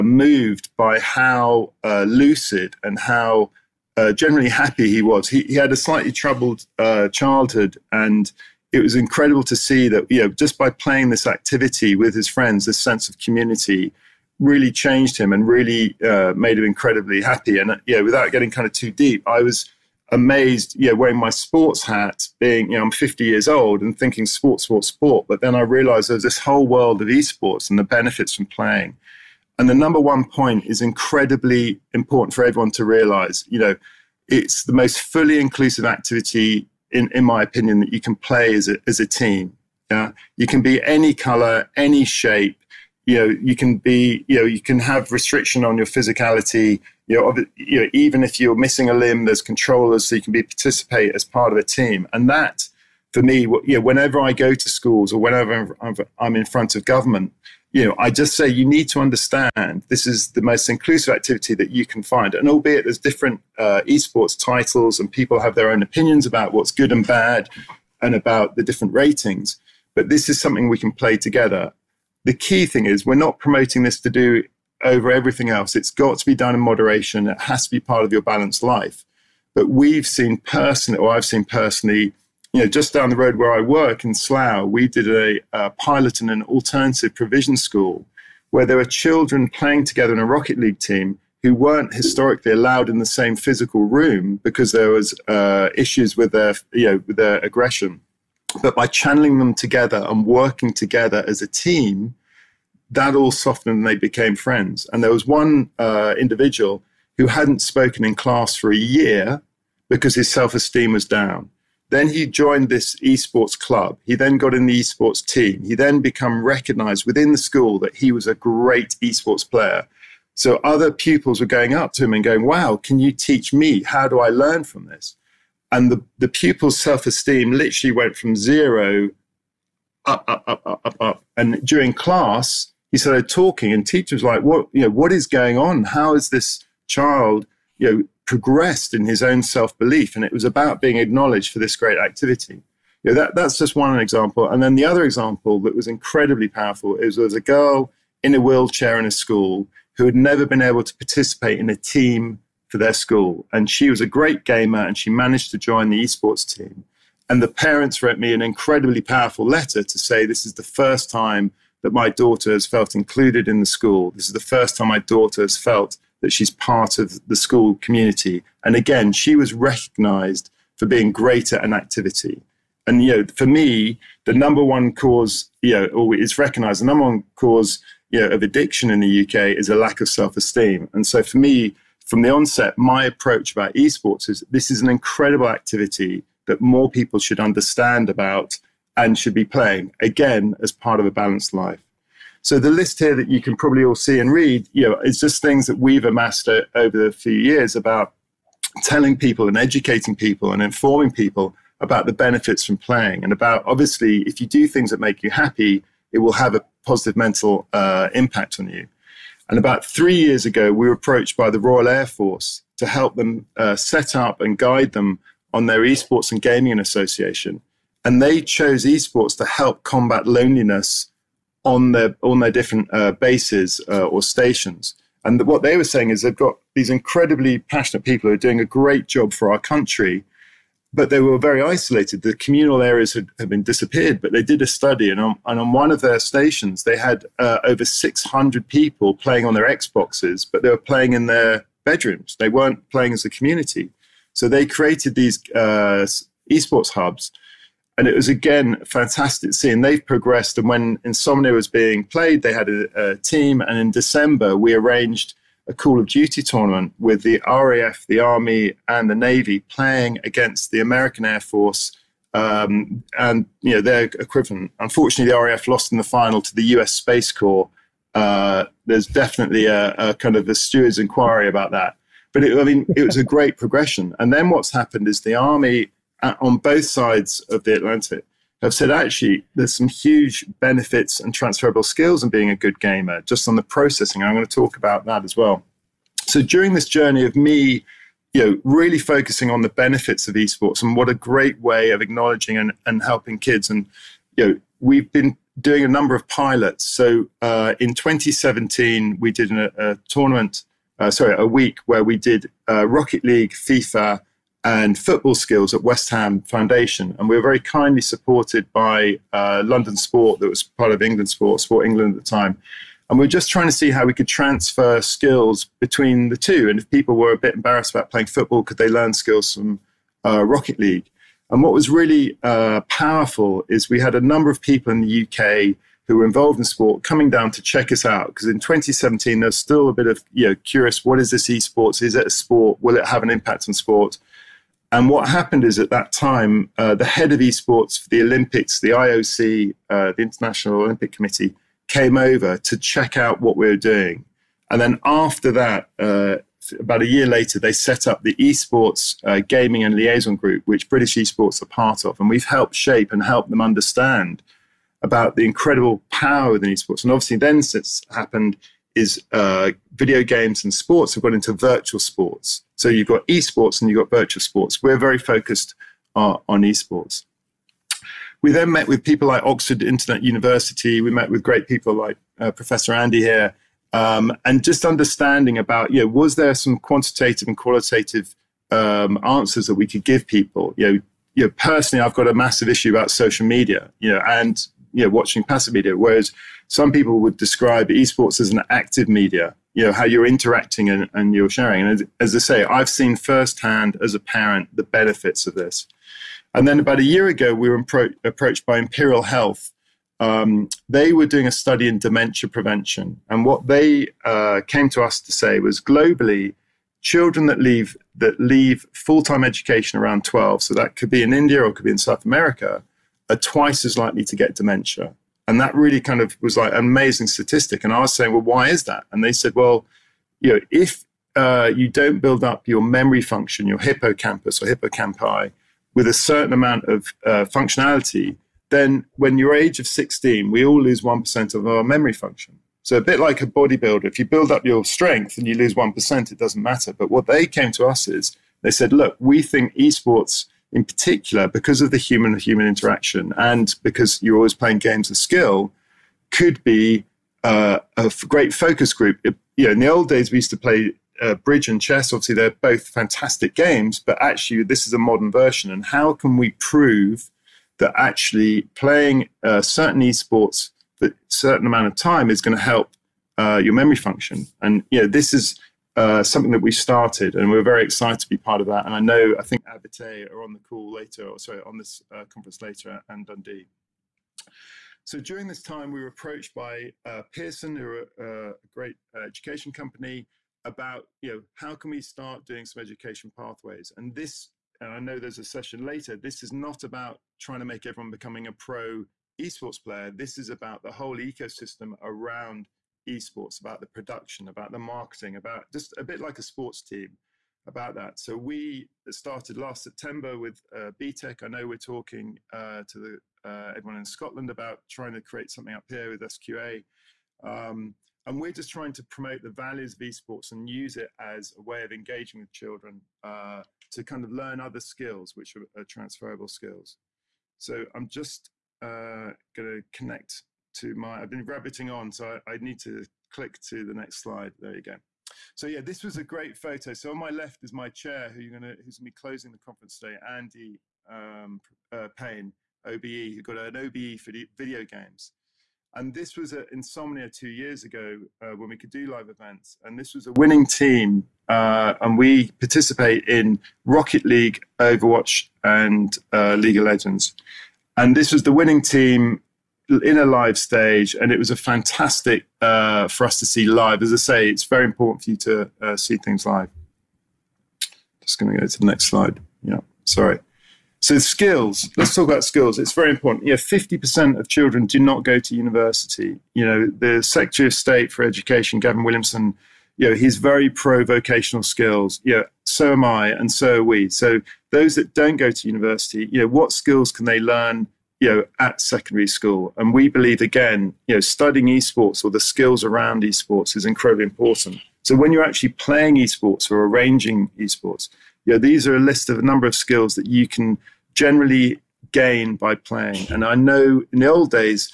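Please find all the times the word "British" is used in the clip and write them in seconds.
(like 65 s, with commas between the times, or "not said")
350 s.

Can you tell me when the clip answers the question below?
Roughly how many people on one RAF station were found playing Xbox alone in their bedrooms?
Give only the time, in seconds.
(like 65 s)
237 s.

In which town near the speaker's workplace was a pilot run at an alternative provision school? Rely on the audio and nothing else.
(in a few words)
Slough.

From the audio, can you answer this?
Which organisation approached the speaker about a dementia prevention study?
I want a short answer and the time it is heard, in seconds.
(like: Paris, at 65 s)
Imperial Health, at 398 s.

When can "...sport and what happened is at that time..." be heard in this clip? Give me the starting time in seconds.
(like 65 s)
333 s.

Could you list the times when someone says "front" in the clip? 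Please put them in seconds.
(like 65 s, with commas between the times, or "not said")
56 s.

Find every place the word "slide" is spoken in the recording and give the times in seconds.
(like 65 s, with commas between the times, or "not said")
524 s, 559 s.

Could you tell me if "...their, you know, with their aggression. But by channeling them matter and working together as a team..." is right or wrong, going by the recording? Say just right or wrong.
wrong.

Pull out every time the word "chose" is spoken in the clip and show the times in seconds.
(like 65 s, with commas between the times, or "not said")
218 s.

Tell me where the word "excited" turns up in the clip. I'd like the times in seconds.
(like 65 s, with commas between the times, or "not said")
467 s.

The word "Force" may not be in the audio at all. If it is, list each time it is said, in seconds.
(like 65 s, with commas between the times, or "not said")
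212 s, 261 s.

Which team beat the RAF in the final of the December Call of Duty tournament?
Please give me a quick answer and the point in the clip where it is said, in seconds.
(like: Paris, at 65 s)
U.S. Space Corps, at 266 s.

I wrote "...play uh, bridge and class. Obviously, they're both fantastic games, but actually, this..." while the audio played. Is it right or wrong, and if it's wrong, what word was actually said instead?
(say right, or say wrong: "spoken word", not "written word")
wrong: "chess", not "class".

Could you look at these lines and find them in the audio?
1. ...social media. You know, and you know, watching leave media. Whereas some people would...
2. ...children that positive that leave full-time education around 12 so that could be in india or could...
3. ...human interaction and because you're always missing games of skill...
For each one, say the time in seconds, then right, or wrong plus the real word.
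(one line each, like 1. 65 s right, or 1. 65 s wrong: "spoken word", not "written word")
1. 383 s wrong: "passive", not "leave"
2. 407 s wrong: "leave", not "positive"
3. 442 s wrong: "playing", not "missing".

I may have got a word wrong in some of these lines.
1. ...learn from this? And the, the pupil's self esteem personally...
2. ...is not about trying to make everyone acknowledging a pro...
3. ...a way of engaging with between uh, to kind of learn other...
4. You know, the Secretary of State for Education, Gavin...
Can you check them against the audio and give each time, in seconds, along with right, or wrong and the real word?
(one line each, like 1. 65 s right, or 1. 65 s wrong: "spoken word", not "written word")
1. 124 s wrong: "literally", not "personally"
2. 486 s wrong: "becoming", not "acknowledging"
3. 511 s wrong: "children", not "between"
4. 566 s right.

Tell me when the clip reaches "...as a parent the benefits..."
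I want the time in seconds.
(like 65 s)
394 s.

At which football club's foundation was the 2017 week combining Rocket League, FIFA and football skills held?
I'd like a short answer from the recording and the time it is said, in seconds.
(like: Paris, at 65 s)
West Ham Foundation, at 305 s.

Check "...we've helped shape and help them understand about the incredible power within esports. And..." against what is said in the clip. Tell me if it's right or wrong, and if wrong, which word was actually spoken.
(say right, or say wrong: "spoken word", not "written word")
right.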